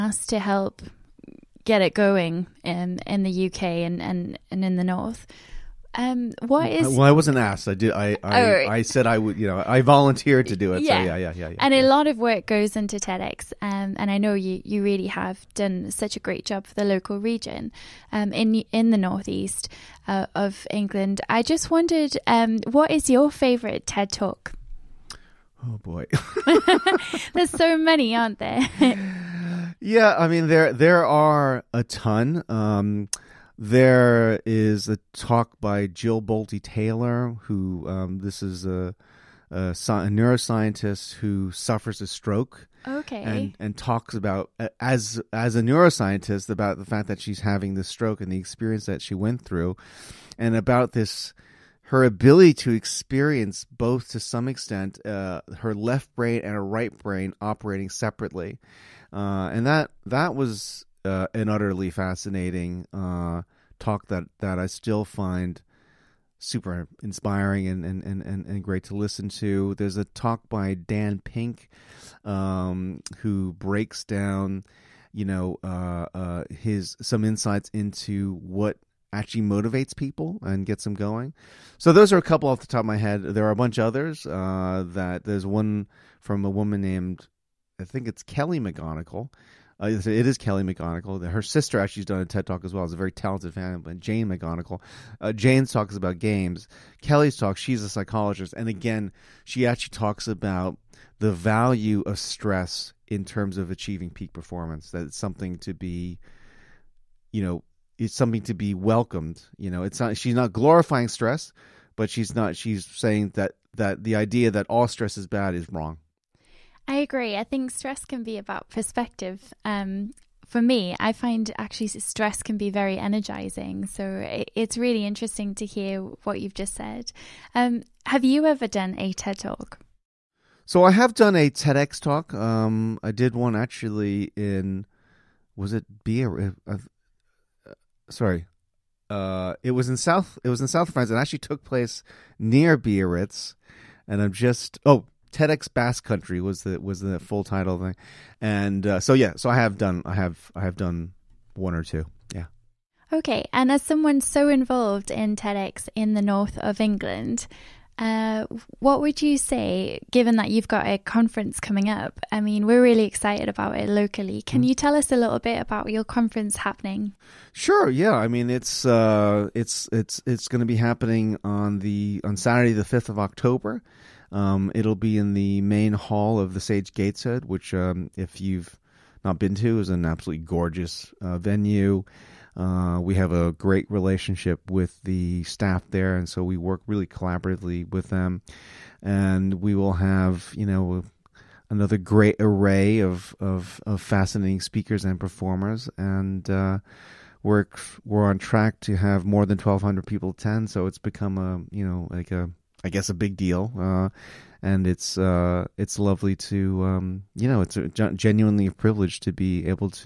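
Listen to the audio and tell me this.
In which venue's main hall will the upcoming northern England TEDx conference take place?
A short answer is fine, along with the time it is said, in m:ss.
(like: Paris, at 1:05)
Sage Gateshead, at 2:56.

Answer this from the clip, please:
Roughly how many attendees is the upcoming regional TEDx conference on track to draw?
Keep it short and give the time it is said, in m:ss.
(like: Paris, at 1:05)
more than 1,200, at 3:19.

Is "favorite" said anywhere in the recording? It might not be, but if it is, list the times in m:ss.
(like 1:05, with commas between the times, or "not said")
0:23.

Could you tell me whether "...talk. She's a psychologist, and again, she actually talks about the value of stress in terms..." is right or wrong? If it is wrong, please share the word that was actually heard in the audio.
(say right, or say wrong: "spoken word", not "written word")
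right.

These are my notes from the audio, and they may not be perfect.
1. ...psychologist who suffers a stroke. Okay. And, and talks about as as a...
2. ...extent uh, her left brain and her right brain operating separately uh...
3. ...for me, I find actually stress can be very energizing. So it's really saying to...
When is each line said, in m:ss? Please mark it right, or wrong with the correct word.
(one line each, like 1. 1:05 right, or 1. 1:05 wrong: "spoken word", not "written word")
1. 0:40 wrong: "neuroscientist", not "psychologist"
2. 0:54 right
3. 2:00 wrong: "interesting", not "saying".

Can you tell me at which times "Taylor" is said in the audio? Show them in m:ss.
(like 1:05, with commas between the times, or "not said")
0:36.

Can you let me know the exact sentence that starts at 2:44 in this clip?
Can mm you tell us a little bit about your conference happening?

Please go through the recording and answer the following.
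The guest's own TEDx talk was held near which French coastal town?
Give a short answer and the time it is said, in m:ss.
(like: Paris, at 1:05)
Biarritz, at 2:22.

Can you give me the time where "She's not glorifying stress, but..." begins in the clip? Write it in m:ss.
1:50.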